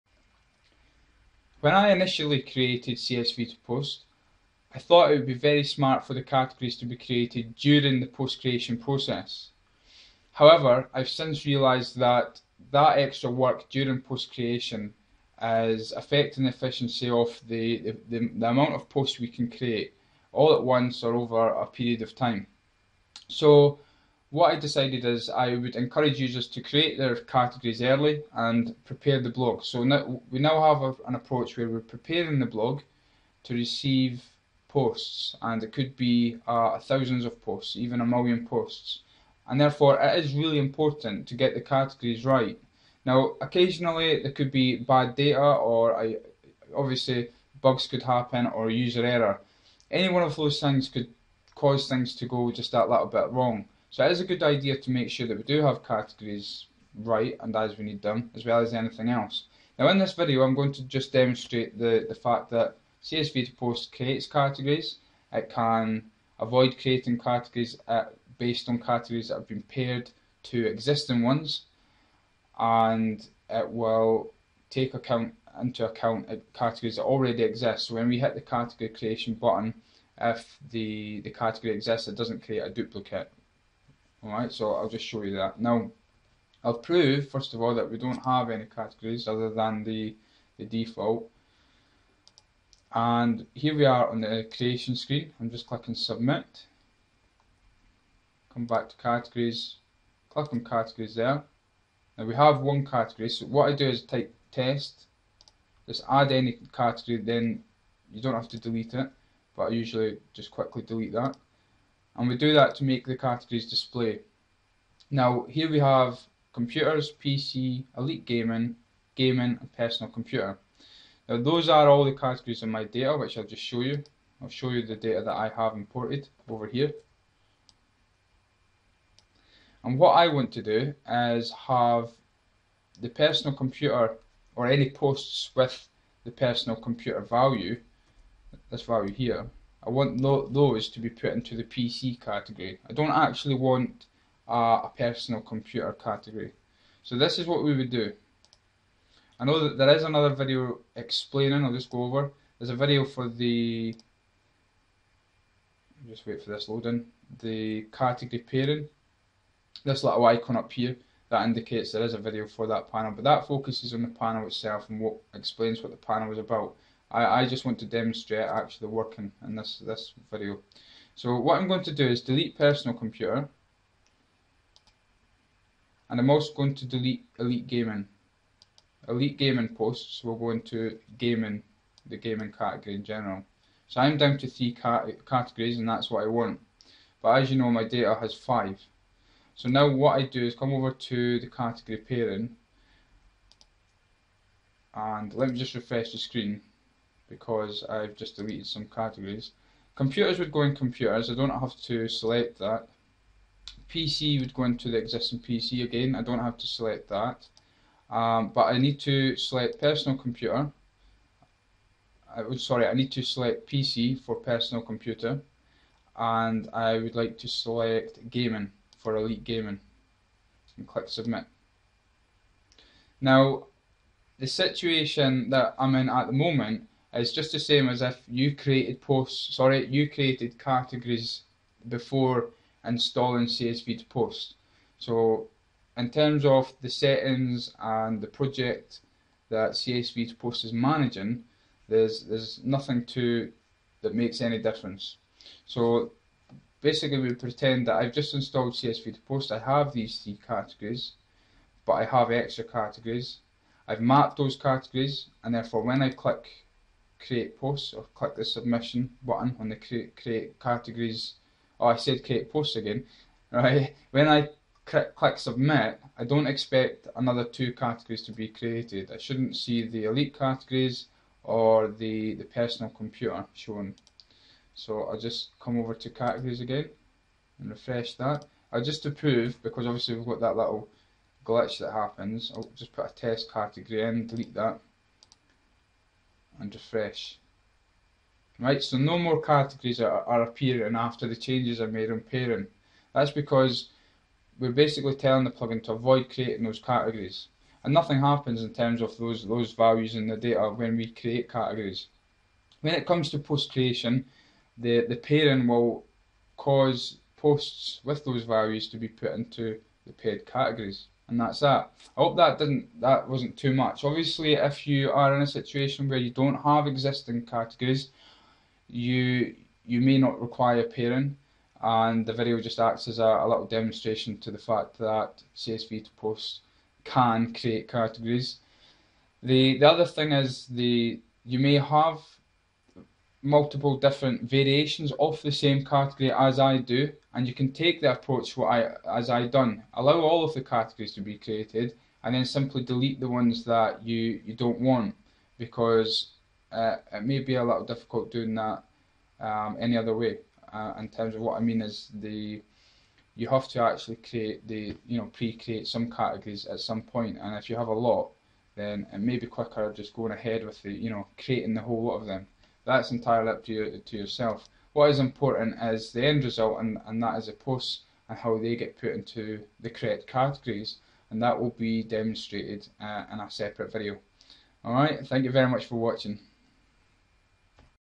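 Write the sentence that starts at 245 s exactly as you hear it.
So basically we pretend that I've just installed CSV 2 POST, I have these three categories, but I have extra categories.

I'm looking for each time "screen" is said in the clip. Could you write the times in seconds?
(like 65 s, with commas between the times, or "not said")
94 s, 196 s.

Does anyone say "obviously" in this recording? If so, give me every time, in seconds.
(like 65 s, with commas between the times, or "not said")
46 s, 279 s, 314 s.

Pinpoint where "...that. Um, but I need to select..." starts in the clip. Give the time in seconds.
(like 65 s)
207 s.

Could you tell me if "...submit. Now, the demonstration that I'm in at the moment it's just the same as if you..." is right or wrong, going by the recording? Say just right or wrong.
wrong.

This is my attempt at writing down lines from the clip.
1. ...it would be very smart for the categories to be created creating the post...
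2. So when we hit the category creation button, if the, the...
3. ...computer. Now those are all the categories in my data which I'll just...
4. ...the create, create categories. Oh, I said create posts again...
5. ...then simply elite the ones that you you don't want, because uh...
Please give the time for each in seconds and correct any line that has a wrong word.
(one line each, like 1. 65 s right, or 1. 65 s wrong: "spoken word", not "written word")
1. 5 s wrong: "during", not "creating"
2. 77 s right
3. 120 s right
4. 259 s right
5. 342 s wrong: "delete", not "elite".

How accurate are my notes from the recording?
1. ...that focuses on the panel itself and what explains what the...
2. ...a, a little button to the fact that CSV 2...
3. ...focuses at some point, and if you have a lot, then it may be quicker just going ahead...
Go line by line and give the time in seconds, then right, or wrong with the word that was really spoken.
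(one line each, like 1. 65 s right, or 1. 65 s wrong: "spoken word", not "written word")
1. 163 s right
2. 323 s wrong: "demonstration", not "button"
3. 356 s wrong: "categories", not "focuses".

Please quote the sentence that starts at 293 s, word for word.
That's because we're basically telling the plugin to avoid creating those categories.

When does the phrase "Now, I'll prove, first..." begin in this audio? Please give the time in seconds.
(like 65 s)
85 s.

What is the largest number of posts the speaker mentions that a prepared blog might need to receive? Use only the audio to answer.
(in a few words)
a million.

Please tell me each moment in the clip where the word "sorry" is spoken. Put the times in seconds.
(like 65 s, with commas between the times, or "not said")
212 s, 229 s.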